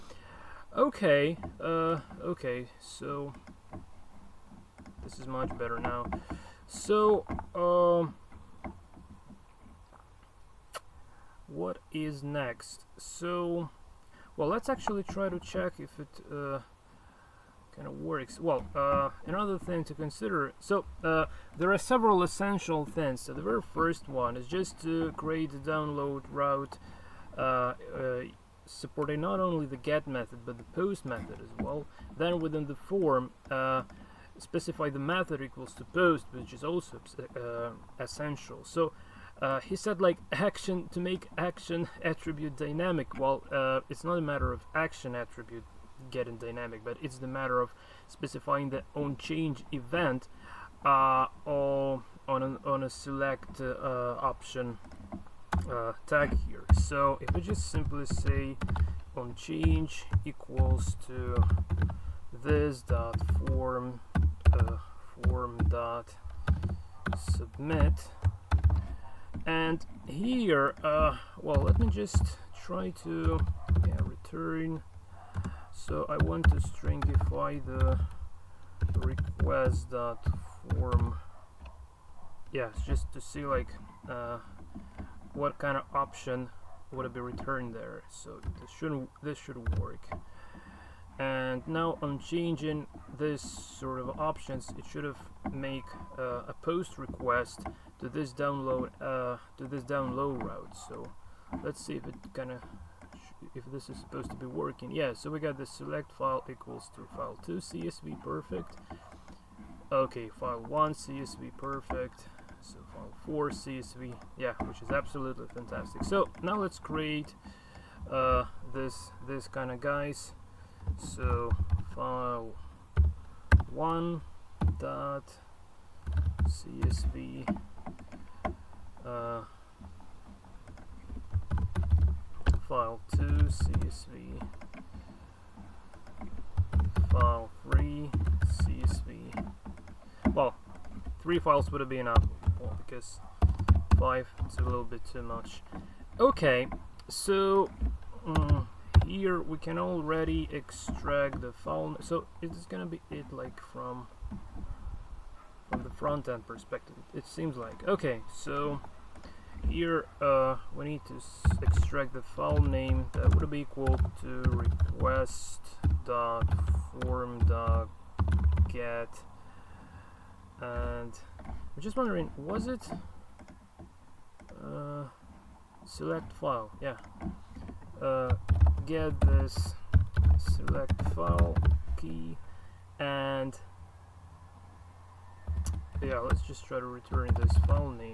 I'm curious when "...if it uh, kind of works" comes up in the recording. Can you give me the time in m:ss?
0:15.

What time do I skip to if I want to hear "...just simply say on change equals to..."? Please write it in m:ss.
0:57.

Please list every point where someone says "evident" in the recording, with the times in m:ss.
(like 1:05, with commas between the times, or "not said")
not said.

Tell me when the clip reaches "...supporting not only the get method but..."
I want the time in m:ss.
0:28.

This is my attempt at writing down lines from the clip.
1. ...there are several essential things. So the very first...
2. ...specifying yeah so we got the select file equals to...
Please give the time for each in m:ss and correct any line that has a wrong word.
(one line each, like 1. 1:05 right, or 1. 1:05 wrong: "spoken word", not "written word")
1. 0:21 right
2. 1:44 wrong: "working", not "specifying".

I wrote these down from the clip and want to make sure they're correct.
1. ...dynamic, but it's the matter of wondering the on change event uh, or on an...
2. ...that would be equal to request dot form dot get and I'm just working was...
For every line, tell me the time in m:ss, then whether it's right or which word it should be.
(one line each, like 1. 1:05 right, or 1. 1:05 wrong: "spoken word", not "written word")
1. 0:46 wrong: "specifying", not "wondering"
2. 2:43 wrong: "wondering", not "working".